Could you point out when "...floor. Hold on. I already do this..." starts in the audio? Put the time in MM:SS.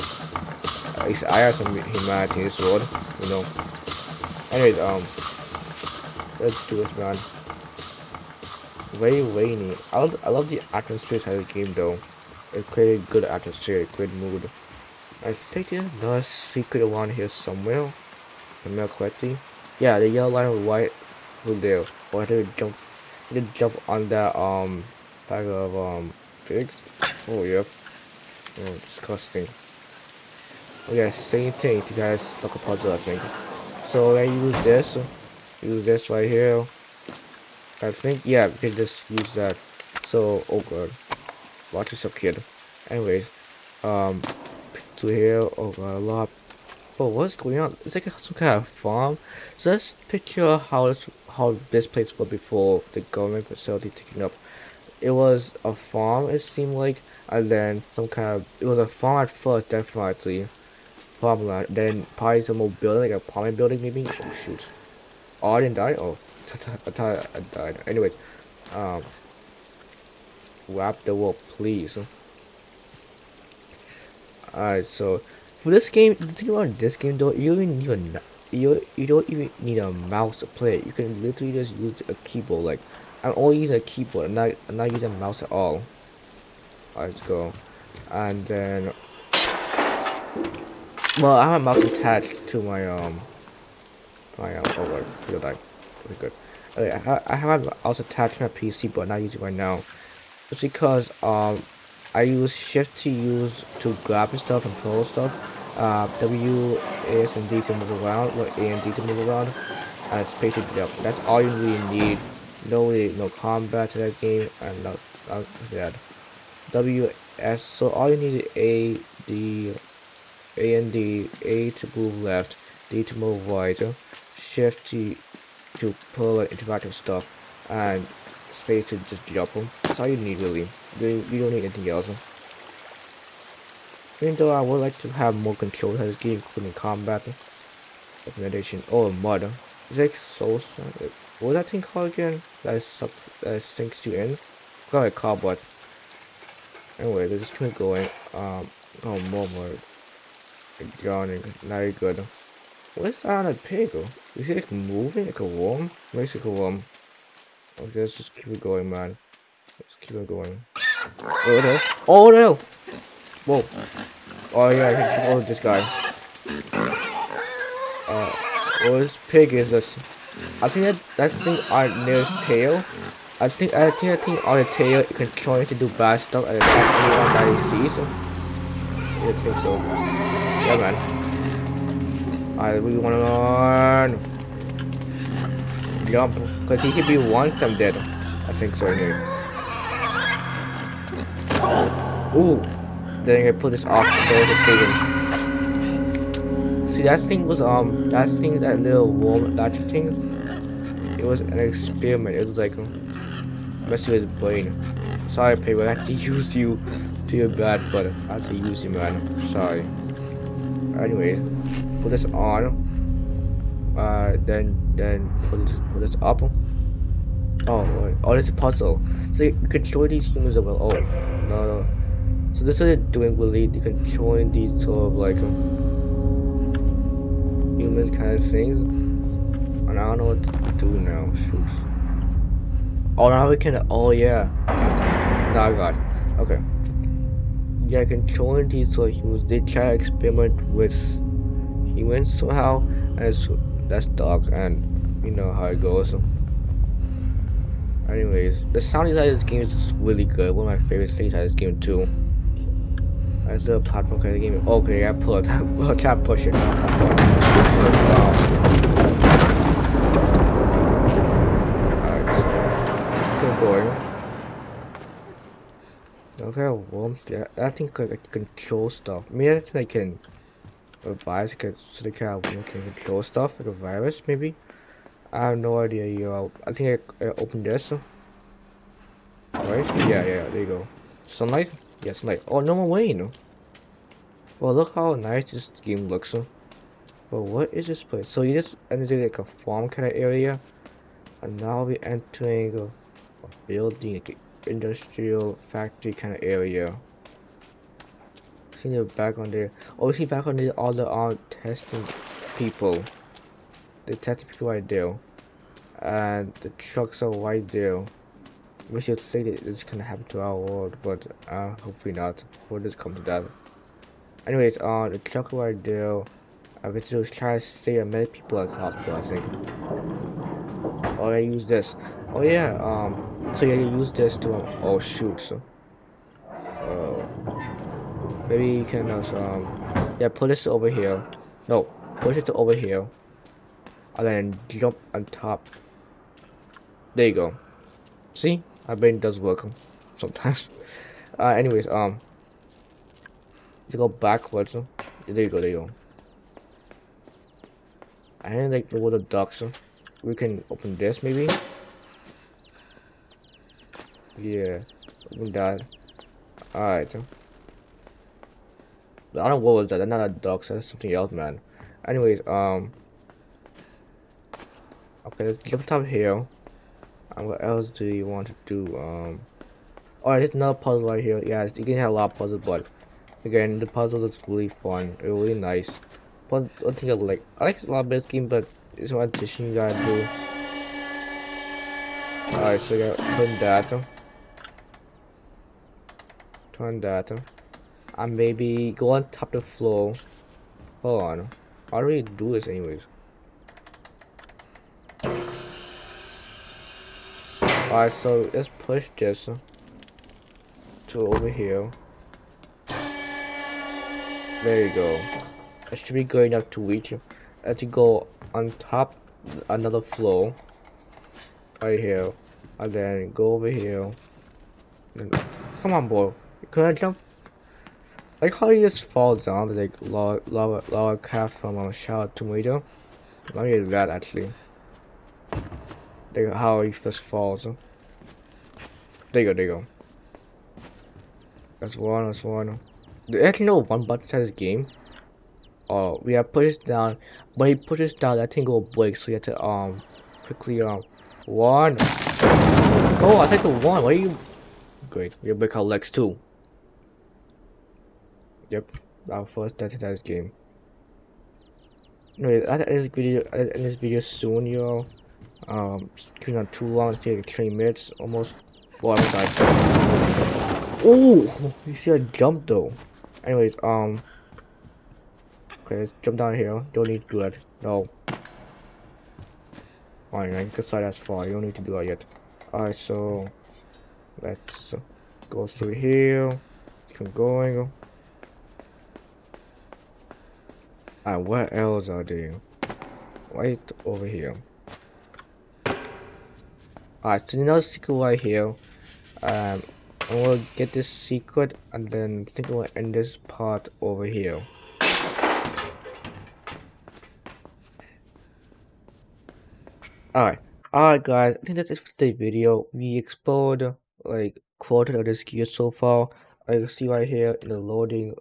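06:29.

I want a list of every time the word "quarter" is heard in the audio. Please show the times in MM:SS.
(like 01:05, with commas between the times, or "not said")
08:24.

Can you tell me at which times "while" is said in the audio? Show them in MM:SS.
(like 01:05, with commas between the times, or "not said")
not said.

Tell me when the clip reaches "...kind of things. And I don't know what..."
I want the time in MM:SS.
03:48.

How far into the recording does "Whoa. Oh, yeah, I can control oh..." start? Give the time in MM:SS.
02:43.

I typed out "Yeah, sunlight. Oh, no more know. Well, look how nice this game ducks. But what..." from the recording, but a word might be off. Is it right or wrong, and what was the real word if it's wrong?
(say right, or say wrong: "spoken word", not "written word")
wrong: "looks", not "ducks".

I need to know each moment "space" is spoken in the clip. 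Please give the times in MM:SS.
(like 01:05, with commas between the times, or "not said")
01:50, 02:08.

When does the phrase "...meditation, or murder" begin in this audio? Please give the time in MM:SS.
02:18.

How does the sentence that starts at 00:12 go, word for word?
It created good atmosphere, good mood.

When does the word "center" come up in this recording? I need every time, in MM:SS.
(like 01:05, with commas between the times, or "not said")
not said.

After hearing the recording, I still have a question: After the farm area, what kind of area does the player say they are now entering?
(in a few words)
Industrial factory.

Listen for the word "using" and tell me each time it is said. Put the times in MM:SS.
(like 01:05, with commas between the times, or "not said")
01:24, 01:39.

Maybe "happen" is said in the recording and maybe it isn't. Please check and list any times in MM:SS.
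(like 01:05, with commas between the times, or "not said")
05:10.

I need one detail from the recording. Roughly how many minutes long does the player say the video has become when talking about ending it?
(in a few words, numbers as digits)
20.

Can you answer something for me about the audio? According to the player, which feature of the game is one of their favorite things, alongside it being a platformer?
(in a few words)
Sound design.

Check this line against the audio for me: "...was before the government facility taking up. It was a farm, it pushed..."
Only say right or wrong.
wrong.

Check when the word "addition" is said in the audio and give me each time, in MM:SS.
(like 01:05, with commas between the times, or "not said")
06:19.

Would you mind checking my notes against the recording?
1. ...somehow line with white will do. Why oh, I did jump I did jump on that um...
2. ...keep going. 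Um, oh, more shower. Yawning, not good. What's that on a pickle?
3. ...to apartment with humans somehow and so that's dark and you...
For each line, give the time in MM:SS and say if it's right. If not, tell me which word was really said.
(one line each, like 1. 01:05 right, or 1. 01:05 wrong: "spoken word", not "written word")
1. 00:20 wrong: "yellow", not "somehow"
2. 02:27 wrong: "murder", not "shower"
3. 03:59 wrong: "experiment", not "apartment".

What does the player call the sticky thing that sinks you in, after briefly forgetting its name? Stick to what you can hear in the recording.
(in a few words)
Cobweb.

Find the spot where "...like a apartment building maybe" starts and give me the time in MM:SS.
01:03.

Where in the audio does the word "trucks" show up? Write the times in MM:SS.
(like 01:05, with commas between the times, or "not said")
05:06, 05:15.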